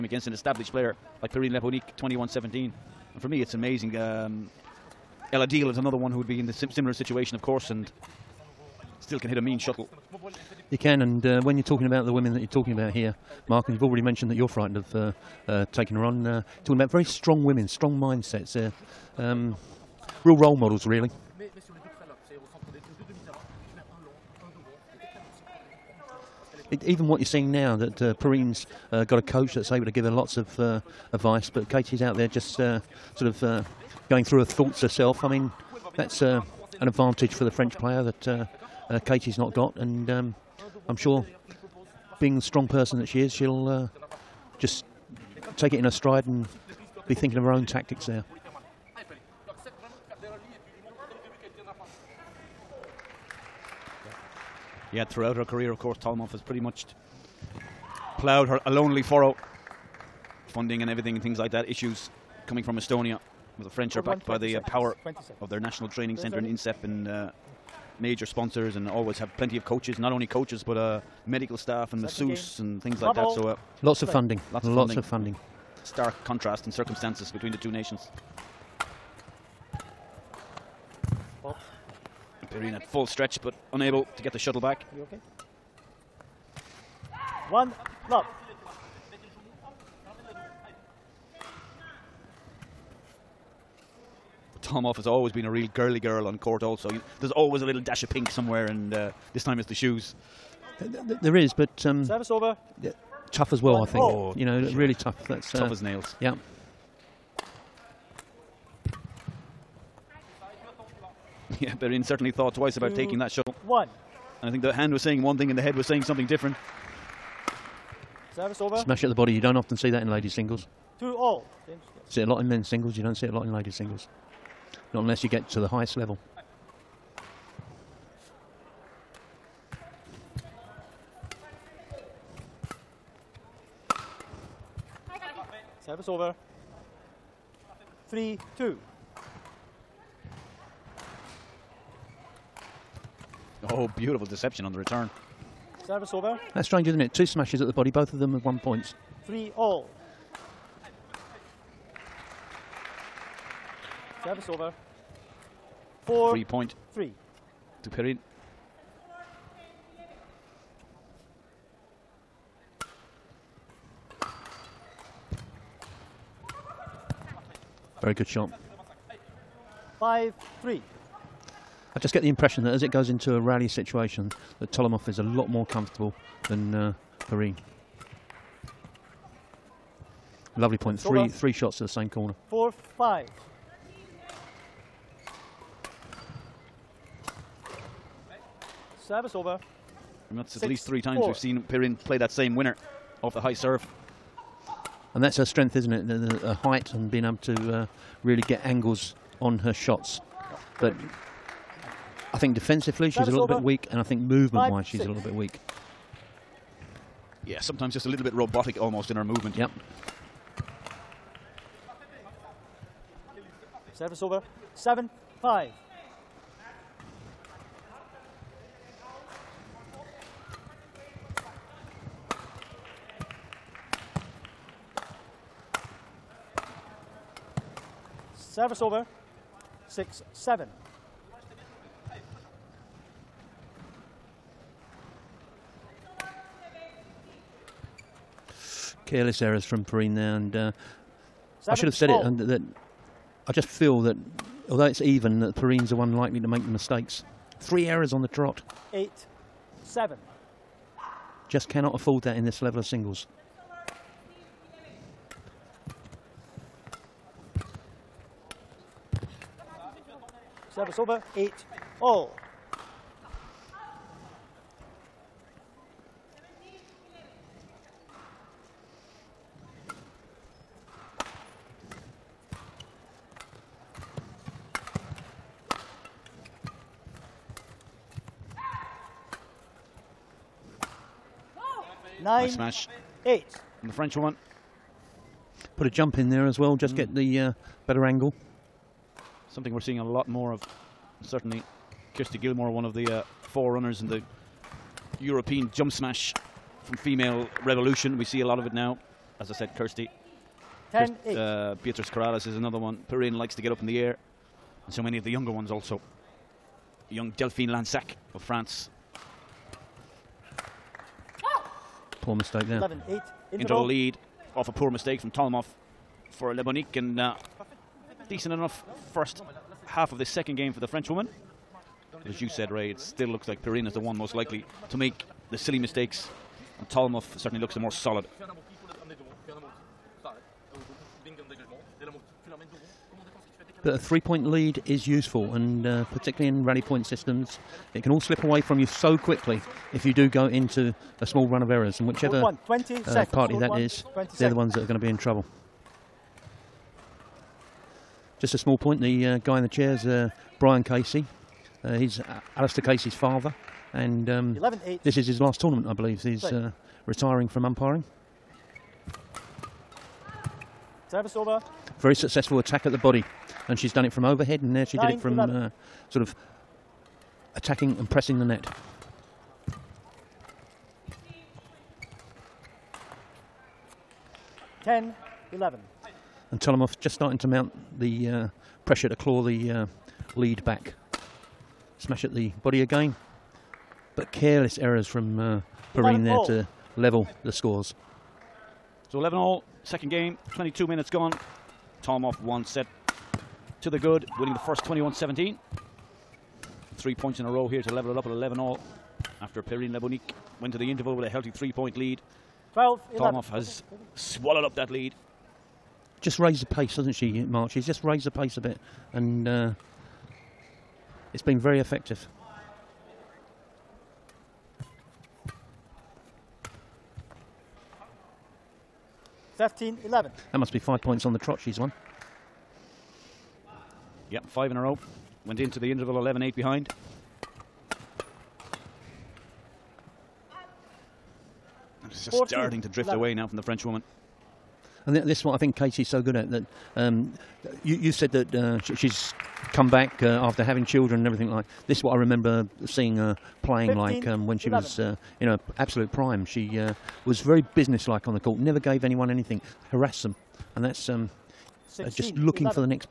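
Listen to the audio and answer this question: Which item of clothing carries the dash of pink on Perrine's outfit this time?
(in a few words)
Shoes.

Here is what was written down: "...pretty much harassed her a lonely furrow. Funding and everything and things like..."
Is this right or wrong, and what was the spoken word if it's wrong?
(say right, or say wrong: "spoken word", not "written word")
wrong: "ploughed", not "harassed".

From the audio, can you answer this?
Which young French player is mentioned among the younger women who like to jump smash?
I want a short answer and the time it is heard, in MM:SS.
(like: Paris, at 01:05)
Delphine Lansac, at 05:07.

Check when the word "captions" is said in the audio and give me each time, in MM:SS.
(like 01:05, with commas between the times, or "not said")
not said.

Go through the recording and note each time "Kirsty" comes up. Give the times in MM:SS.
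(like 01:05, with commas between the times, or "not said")
04:52, 04:59.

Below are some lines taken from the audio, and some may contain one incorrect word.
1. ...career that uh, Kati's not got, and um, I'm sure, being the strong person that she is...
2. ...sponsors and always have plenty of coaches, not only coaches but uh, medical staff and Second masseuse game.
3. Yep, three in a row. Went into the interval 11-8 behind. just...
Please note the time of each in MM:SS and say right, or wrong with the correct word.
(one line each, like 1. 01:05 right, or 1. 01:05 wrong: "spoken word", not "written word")
1. 00:37 wrong: "player", not "career"
2. 01:08 right
3. 07:04 wrong: "five", not "three".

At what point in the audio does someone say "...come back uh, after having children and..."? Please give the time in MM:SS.
07:19.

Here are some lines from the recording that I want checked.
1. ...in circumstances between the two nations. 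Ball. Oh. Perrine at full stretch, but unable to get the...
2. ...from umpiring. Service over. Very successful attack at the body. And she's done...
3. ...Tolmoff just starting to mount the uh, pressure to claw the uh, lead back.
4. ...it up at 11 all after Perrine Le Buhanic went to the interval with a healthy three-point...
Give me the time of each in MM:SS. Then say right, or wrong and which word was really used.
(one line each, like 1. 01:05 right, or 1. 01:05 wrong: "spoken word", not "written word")
1. 01:16 right
2. 05:57 right
3. 06:16 right
4. 06:38 right.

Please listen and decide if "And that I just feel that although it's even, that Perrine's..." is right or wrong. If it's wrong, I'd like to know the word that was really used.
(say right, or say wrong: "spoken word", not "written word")
right.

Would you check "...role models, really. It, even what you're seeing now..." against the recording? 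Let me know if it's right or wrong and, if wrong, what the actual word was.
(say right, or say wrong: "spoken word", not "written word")
right.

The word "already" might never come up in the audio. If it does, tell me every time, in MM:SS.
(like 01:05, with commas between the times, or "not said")
00:13.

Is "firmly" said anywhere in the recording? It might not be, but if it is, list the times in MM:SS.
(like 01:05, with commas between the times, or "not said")
not said.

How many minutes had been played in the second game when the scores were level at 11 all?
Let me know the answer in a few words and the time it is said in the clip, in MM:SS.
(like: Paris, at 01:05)
22, at 06:30.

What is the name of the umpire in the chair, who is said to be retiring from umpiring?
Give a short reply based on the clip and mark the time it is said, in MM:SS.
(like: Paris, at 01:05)
Brian Casey, at 05:50.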